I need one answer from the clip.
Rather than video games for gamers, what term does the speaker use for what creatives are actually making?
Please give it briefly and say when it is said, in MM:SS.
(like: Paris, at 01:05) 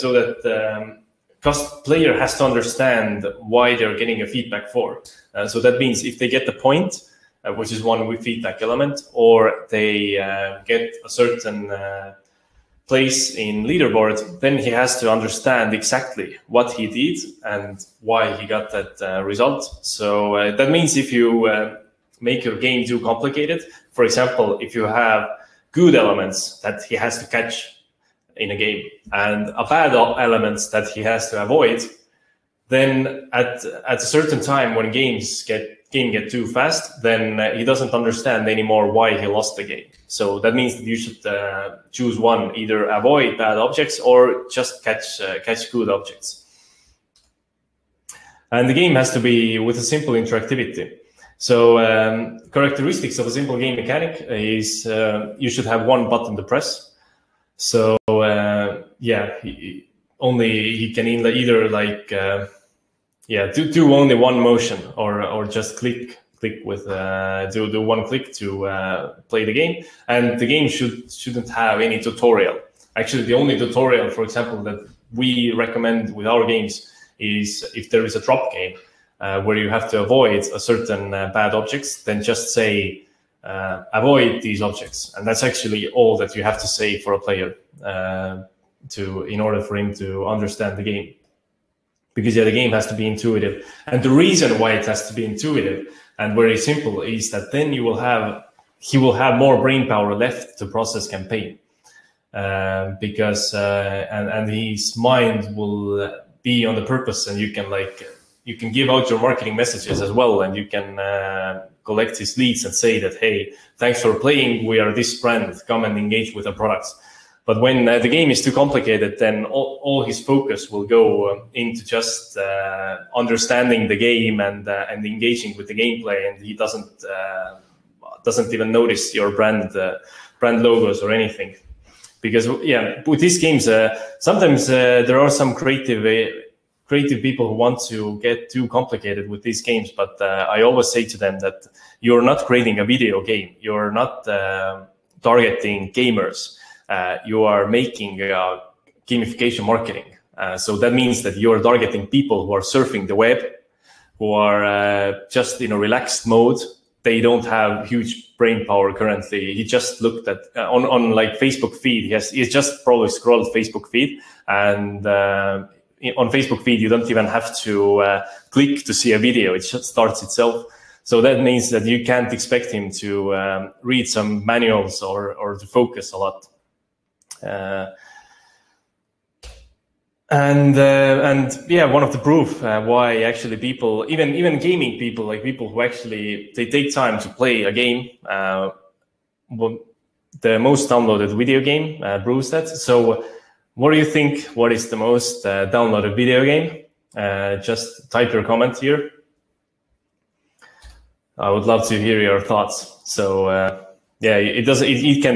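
gamification marketing, at 02:29.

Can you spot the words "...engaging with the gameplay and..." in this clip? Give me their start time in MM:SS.
02:05.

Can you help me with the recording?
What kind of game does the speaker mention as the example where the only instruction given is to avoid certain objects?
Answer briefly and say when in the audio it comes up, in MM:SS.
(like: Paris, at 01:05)
drop game, at 01:18.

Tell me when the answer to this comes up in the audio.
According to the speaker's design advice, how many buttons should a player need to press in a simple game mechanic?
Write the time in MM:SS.
00:55.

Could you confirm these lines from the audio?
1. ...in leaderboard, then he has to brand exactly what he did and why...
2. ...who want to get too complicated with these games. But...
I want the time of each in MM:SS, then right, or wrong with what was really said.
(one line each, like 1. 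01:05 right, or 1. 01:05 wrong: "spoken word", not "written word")
1. 00:13 wrong: "understand", not "brand"
2. 02:17 right.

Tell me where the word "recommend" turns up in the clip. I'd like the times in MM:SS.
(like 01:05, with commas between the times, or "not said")
01:15.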